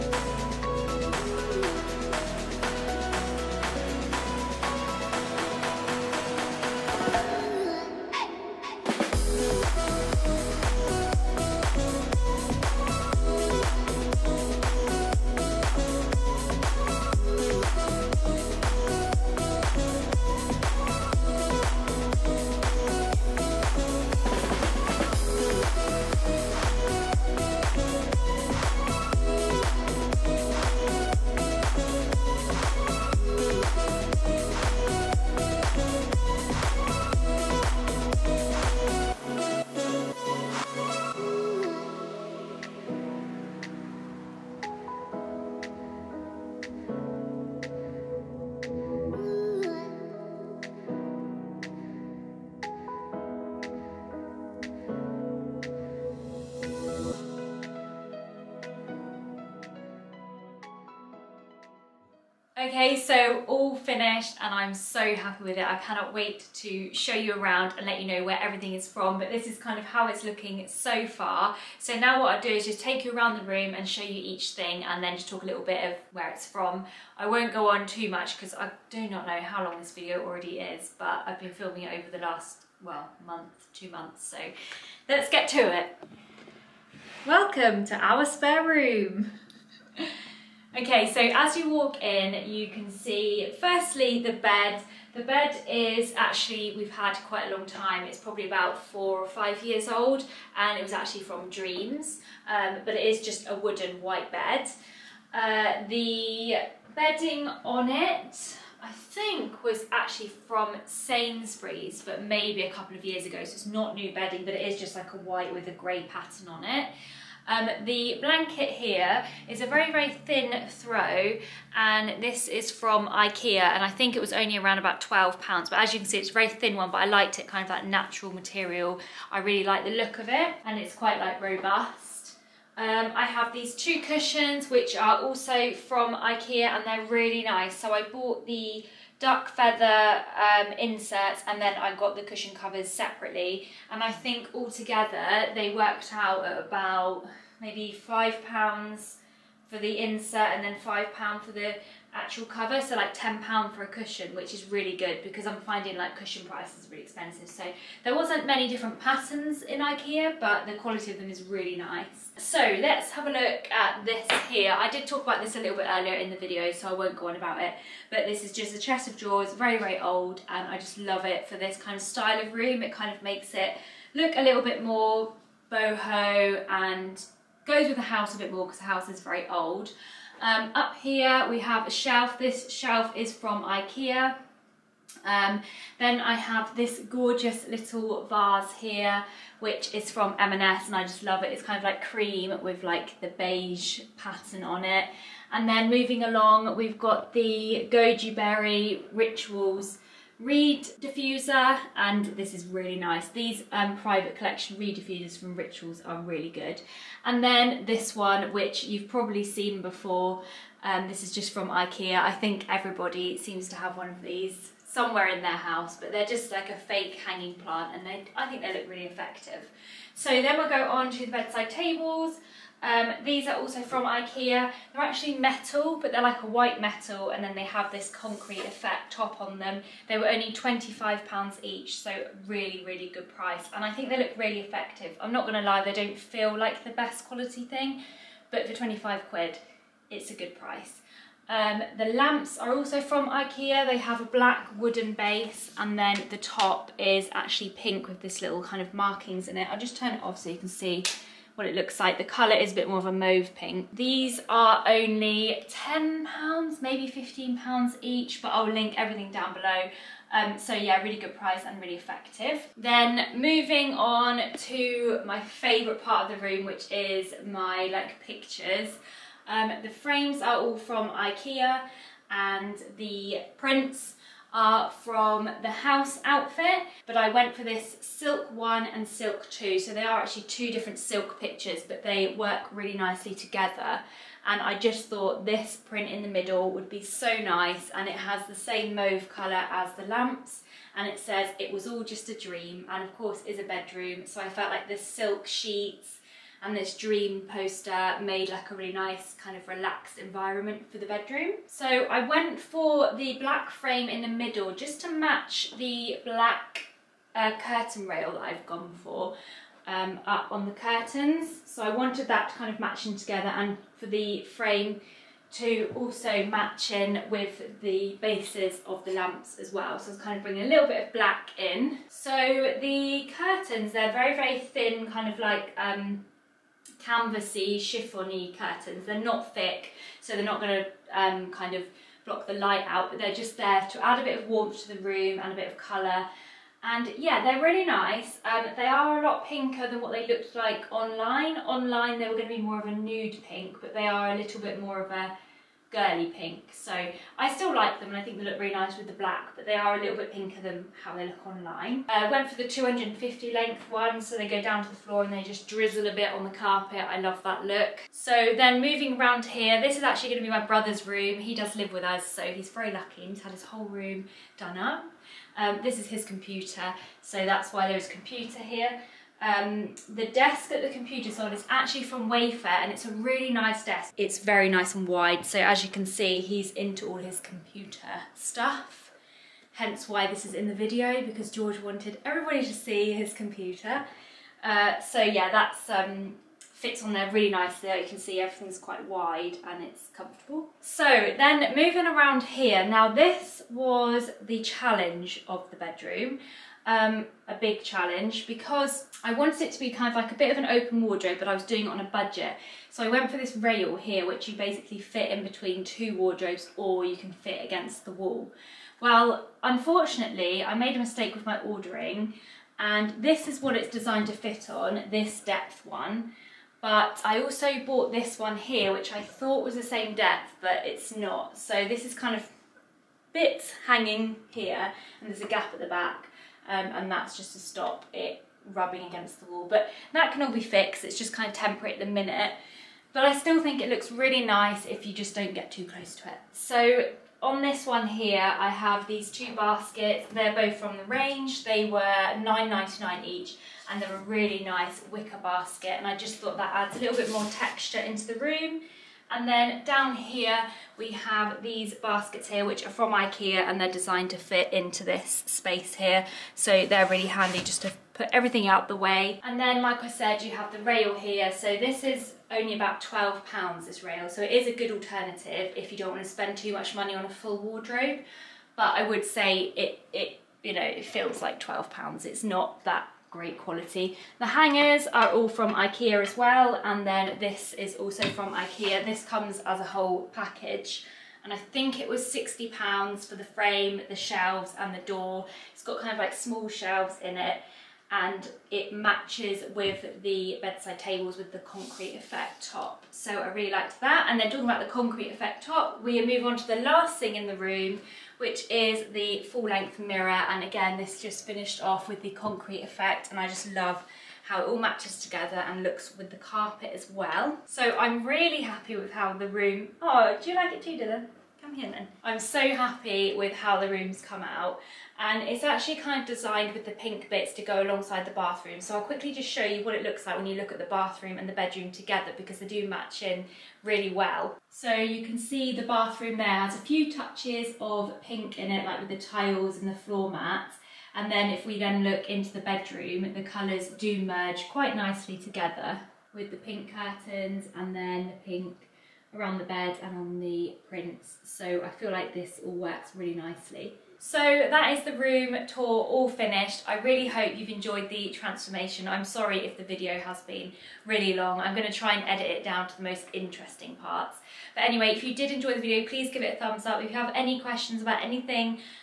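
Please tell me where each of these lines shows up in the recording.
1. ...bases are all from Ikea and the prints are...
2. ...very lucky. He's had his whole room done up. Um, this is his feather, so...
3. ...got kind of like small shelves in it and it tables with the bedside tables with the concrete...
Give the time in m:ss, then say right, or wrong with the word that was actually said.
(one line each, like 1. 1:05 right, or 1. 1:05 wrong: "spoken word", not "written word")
1. 4:29 wrong: "frames", not "bases"
2. 6:02 wrong: "computer", not "feather"
3. 8:05 wrong: "matches", not "tables".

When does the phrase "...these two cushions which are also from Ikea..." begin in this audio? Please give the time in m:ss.
2:13.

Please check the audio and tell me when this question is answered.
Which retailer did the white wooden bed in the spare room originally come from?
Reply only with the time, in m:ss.
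1:41.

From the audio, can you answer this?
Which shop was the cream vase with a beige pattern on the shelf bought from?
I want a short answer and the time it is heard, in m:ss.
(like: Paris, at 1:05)
M&S, at 3:10.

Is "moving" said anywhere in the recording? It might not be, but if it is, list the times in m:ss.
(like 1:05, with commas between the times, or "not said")
3:15, 4:23, 5:58, 6:31.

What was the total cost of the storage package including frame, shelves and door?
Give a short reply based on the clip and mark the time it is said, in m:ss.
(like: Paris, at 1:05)
£60, at 8:02.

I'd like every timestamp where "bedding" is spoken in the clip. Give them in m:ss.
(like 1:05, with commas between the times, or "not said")
1:46, 1:54.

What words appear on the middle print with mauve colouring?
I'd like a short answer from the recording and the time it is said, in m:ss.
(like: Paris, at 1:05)
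It was all just a dream, at 4:51.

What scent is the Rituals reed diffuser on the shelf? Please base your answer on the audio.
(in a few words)
Goji berry.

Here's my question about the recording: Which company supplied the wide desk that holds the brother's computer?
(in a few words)
Wayfair.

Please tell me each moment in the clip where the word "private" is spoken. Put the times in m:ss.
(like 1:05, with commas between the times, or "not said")
3:23.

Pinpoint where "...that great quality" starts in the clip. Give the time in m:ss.
7:52.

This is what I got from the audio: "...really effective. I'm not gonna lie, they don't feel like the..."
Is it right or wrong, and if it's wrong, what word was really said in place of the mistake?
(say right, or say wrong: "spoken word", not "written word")
right.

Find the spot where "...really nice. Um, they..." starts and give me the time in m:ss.
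5:37.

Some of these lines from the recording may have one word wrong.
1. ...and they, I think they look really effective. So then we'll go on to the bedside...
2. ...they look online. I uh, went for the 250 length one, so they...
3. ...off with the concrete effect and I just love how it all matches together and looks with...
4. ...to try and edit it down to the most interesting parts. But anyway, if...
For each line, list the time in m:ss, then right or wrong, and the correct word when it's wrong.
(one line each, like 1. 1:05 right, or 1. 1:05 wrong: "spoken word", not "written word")
1. 3:37 right
2. 5:51 right
3. 8:21 right
4. 9:11 right.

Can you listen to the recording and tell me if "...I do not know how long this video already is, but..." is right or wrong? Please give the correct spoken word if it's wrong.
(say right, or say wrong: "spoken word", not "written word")
right.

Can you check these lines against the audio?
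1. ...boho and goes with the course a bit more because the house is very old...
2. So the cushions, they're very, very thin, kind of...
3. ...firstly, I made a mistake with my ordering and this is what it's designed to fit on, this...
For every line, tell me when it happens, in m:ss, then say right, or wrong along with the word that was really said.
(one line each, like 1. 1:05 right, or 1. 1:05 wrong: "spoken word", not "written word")
1. 2:55 wrong: "house", not "course"
2. 5:22 wrong: "curtains", not "cushions"
3. 6:49 wrong: "unfortunately", not "firstly".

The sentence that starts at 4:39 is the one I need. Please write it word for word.
So they are actually two different silk pictures, but they work really nicely together.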